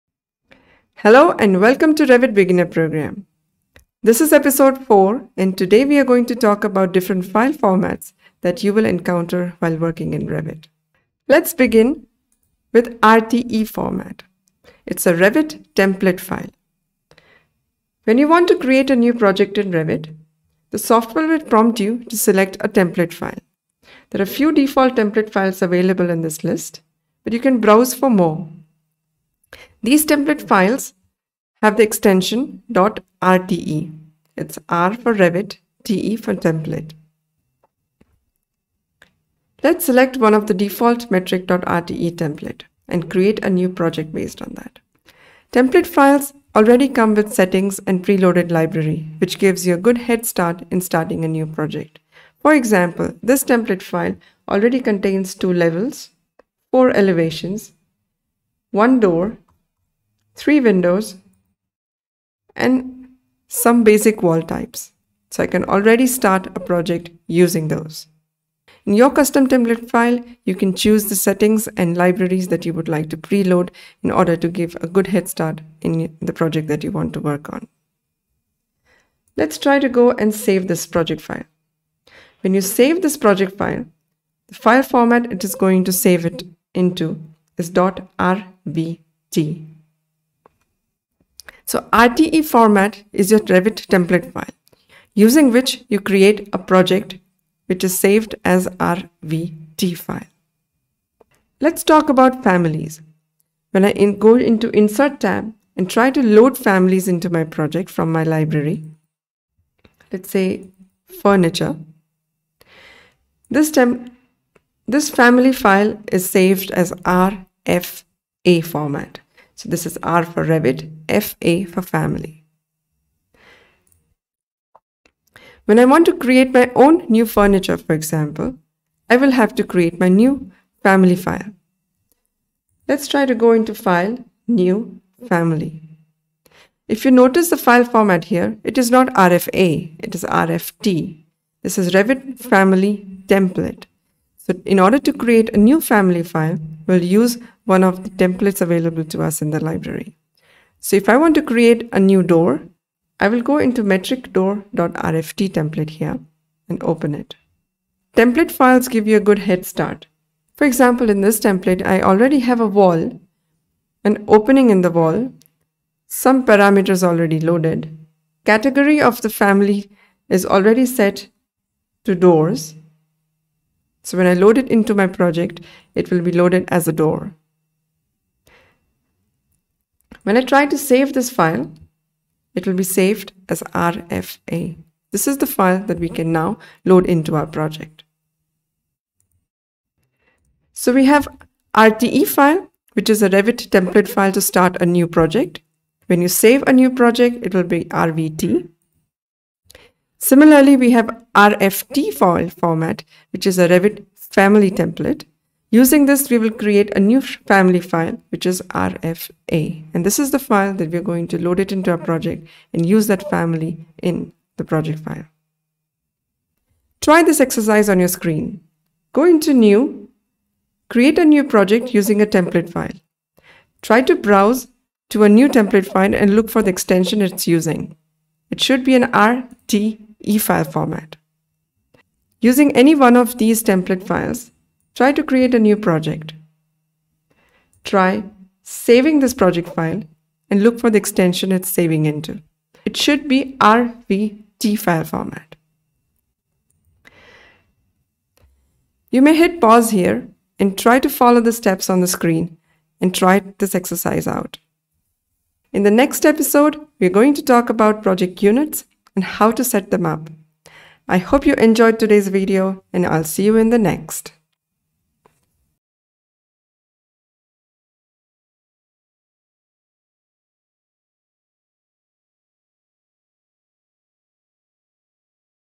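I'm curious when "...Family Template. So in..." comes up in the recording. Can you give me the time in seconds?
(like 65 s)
142 s.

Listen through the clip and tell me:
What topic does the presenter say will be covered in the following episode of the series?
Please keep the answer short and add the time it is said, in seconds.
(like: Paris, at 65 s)
project units, at 258 s.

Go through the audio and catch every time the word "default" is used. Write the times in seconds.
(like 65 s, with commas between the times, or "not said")
24 s, 40 s.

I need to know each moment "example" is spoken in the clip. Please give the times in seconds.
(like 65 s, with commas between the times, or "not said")
52 s, 127 s, 160 s.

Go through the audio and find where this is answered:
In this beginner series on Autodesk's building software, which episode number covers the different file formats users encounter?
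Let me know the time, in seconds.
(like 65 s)
4 s.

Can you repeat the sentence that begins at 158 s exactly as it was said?
Template files give you a good head start.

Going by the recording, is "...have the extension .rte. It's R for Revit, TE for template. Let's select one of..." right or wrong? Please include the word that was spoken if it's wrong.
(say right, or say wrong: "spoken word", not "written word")
right.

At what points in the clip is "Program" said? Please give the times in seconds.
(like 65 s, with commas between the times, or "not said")
2 s.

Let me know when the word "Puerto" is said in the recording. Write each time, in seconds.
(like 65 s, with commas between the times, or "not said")
not said.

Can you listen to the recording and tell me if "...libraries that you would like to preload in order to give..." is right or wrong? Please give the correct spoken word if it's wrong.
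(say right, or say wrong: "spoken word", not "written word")
right.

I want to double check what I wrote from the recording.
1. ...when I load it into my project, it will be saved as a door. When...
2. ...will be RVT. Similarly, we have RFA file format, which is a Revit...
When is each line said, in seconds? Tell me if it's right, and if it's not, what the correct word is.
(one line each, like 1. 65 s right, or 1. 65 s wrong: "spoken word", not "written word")
1. 174 s wrong: "loaded", not "saved"
2. 197 s wrong: "RFT", not "RFA".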